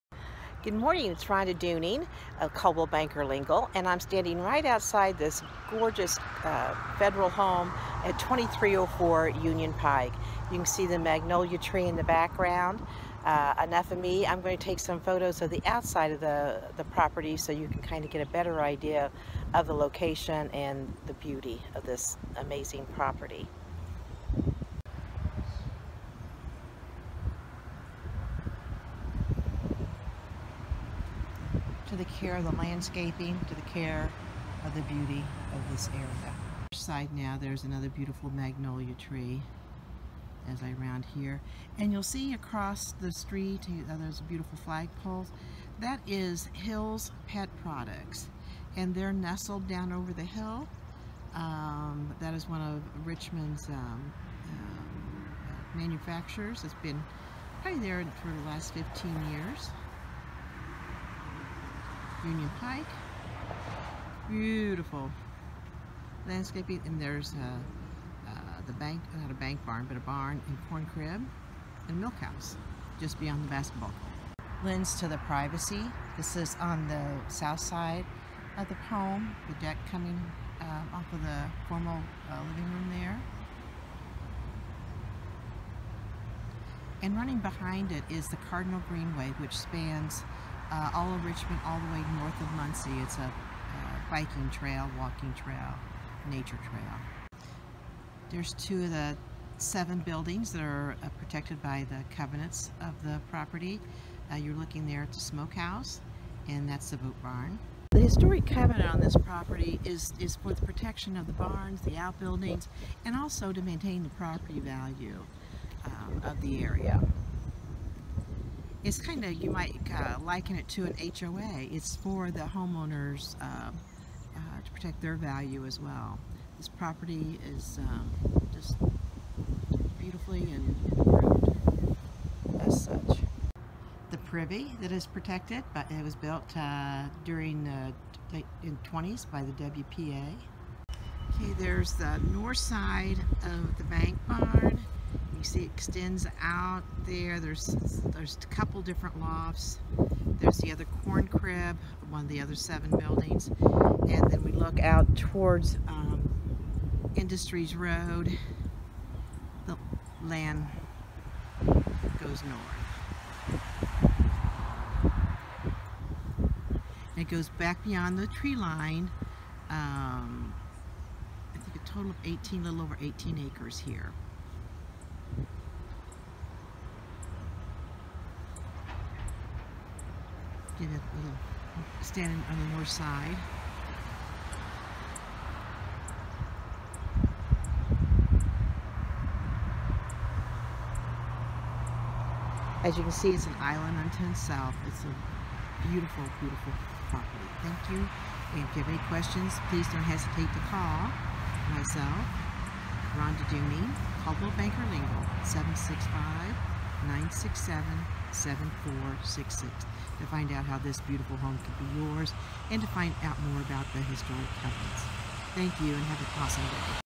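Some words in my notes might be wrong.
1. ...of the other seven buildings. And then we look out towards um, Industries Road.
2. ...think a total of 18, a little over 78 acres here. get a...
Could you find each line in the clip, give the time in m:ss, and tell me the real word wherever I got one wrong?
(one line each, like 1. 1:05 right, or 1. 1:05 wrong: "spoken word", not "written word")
1. 2:32 right
2. 2:51 wrong: "18", not "78".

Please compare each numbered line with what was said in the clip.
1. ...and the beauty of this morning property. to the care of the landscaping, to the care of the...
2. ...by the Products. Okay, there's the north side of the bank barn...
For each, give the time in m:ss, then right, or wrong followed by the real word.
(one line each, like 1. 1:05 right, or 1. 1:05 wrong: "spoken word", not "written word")
1. 0:20 wrong: "amazing", not "morning"
2. 2:19 wrong: "WPA", not "Products".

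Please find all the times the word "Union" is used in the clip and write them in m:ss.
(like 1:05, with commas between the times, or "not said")
0:09, 1:02.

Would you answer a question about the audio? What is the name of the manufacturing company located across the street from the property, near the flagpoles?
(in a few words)
Hill's Pet Products.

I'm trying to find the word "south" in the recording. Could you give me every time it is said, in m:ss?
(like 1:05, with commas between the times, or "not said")
1:17, 3:14.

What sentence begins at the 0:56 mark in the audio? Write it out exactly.
It's been probably there for the last 15 years.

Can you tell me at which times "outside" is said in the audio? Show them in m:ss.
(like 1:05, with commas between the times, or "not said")
0:04, 0:15.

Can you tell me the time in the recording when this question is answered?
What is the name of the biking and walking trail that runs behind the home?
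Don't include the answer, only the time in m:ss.
1:28.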